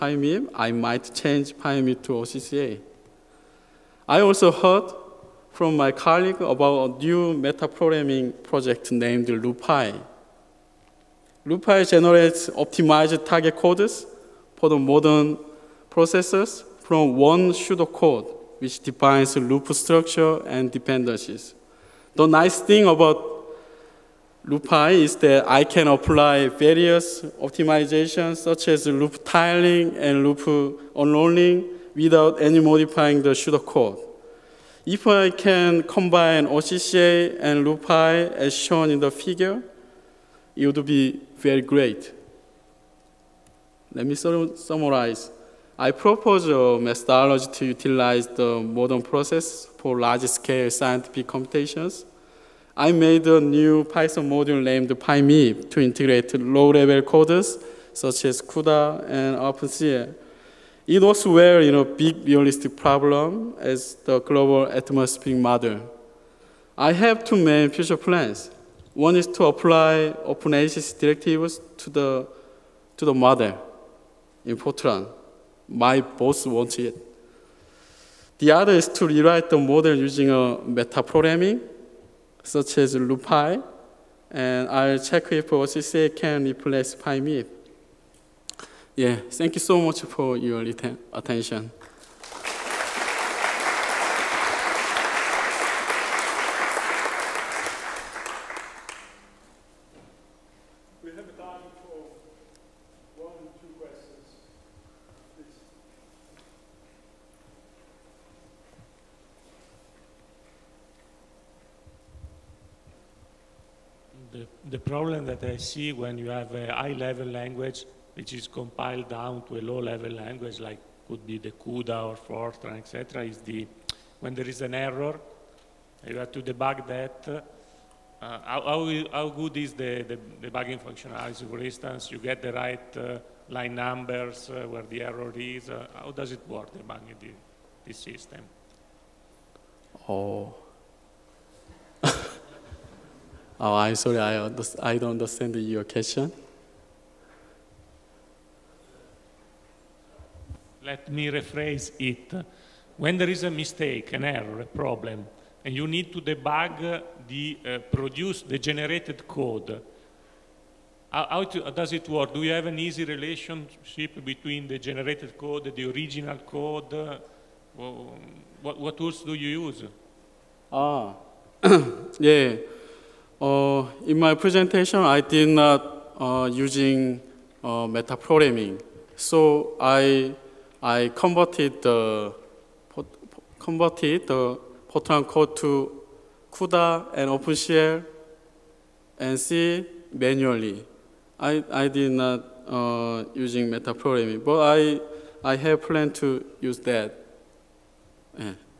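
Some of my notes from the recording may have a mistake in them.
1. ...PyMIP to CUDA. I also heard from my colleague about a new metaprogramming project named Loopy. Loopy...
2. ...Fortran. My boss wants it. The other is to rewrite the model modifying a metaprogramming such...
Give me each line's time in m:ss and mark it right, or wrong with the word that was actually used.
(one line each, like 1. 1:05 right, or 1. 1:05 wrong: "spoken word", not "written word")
1. 0:01 wrong: "OCCA", not "CUDA"
2. 1:14 wrong: "using", not "modifying".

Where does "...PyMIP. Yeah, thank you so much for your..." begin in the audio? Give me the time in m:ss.
1:26.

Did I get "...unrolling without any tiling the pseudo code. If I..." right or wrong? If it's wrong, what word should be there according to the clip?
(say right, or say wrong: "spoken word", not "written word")
wrong: "modifying", not "tiling".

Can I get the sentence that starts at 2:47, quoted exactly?
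what, what tools do you use?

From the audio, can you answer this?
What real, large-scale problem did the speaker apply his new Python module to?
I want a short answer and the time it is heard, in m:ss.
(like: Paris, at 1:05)
global atmospheric model, at 1:04.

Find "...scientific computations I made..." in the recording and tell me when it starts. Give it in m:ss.
0:50.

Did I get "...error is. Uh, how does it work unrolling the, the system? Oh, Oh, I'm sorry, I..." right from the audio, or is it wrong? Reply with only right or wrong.
wrong.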